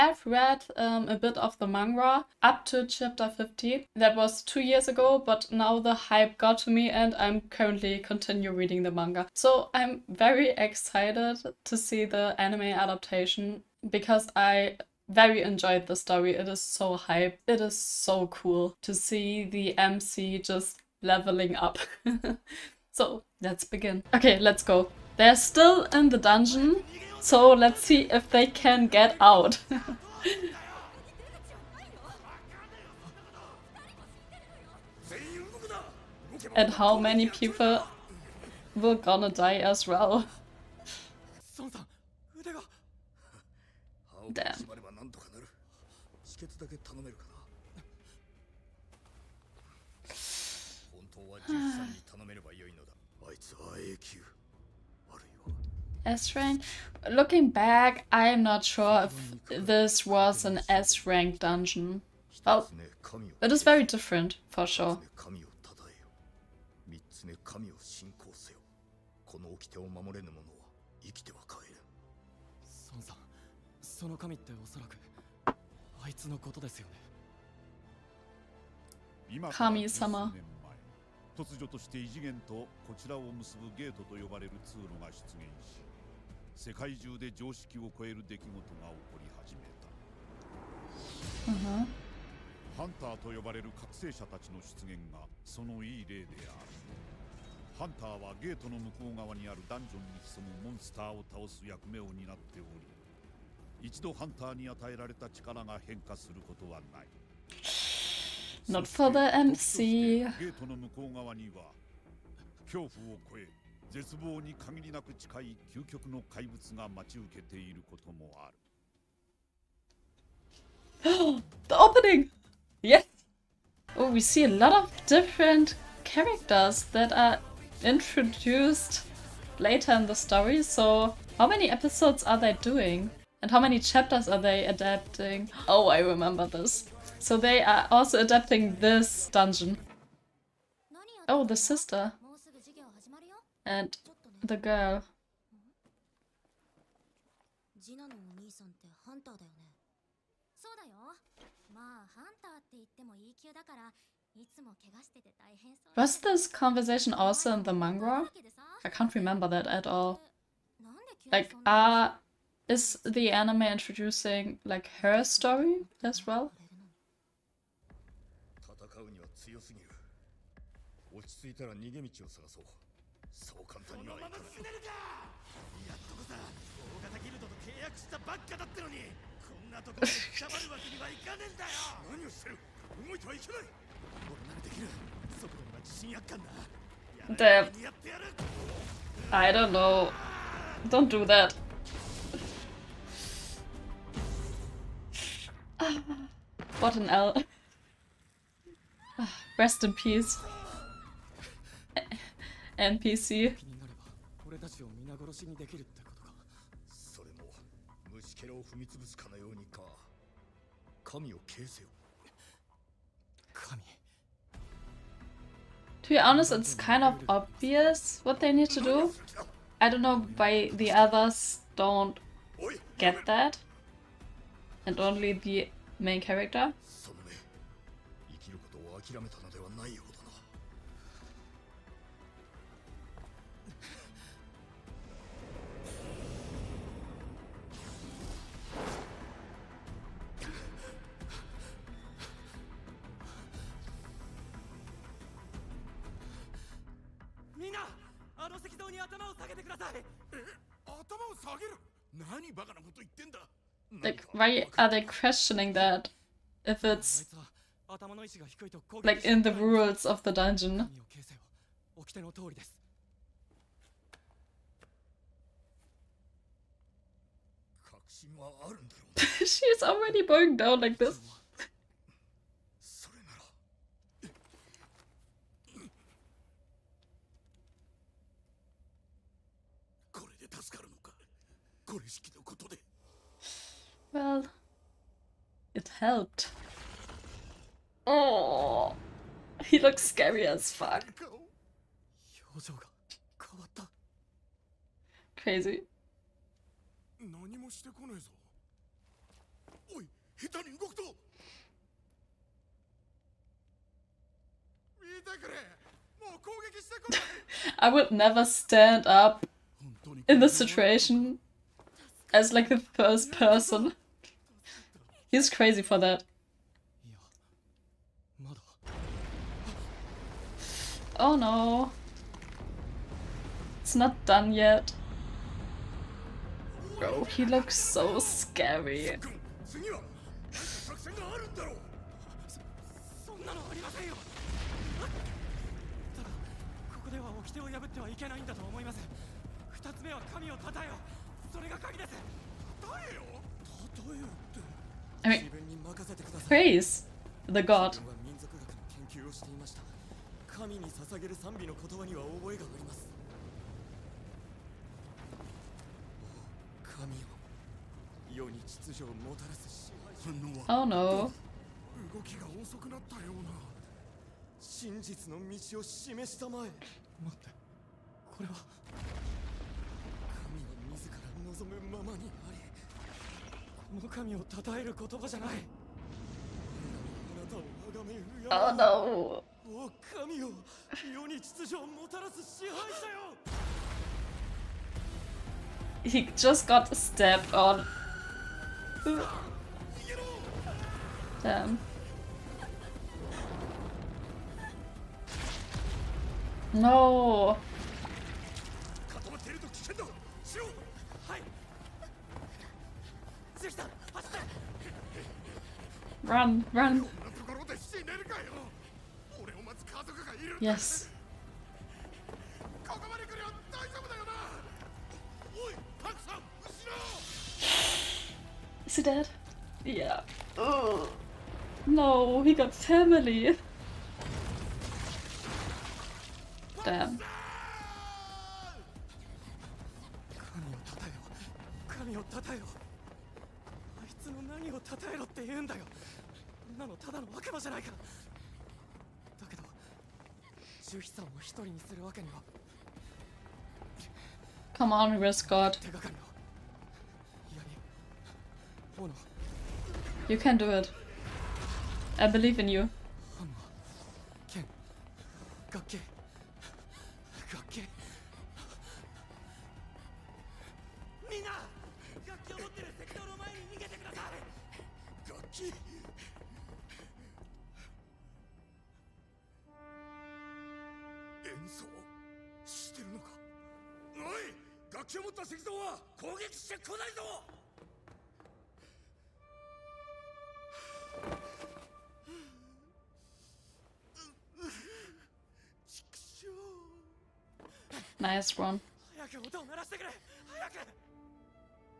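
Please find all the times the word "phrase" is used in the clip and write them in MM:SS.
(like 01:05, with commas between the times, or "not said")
not said.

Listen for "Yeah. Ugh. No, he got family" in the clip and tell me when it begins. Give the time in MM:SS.
06:59.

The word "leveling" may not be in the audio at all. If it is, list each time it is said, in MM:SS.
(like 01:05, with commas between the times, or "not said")
00:21.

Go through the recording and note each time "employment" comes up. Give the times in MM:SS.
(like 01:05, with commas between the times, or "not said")
not said.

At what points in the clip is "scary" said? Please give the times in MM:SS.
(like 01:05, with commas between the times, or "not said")
04:50, 05:28.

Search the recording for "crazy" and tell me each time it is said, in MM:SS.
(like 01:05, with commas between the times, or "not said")
04:55, 05:15.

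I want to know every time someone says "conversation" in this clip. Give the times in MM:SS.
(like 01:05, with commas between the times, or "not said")
02:36.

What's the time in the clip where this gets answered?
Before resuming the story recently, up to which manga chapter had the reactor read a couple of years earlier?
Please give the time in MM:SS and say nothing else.
00:02.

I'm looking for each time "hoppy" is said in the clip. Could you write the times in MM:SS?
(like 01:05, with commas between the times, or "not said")
not said.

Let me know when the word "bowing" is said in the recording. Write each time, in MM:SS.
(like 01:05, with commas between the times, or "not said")
04:30.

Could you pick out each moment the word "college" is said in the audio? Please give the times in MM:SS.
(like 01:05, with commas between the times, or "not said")
not said.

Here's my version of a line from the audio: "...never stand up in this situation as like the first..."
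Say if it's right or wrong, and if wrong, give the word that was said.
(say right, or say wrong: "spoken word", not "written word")
right.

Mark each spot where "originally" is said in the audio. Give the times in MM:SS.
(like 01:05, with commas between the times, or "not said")
not said.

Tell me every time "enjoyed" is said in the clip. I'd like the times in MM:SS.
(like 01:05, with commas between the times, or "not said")
00:15.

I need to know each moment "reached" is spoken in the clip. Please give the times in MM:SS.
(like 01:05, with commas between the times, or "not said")
not said.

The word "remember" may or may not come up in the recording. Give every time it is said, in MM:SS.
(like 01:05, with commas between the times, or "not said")
02:15, 02:39.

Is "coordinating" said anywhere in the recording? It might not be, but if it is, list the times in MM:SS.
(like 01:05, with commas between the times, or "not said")
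not said.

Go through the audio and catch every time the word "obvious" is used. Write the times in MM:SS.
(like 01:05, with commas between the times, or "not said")
03:37.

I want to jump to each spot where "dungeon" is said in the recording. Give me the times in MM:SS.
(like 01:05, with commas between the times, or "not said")
00:26, 01:01, 02:19, 04:20.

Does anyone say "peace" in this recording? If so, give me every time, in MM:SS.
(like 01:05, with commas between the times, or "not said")
03:19.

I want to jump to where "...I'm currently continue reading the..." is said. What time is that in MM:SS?
00:07.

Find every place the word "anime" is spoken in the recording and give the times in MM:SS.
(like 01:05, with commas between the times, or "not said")
00:12, 02:43.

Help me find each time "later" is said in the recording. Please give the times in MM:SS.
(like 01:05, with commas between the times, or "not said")
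02:09.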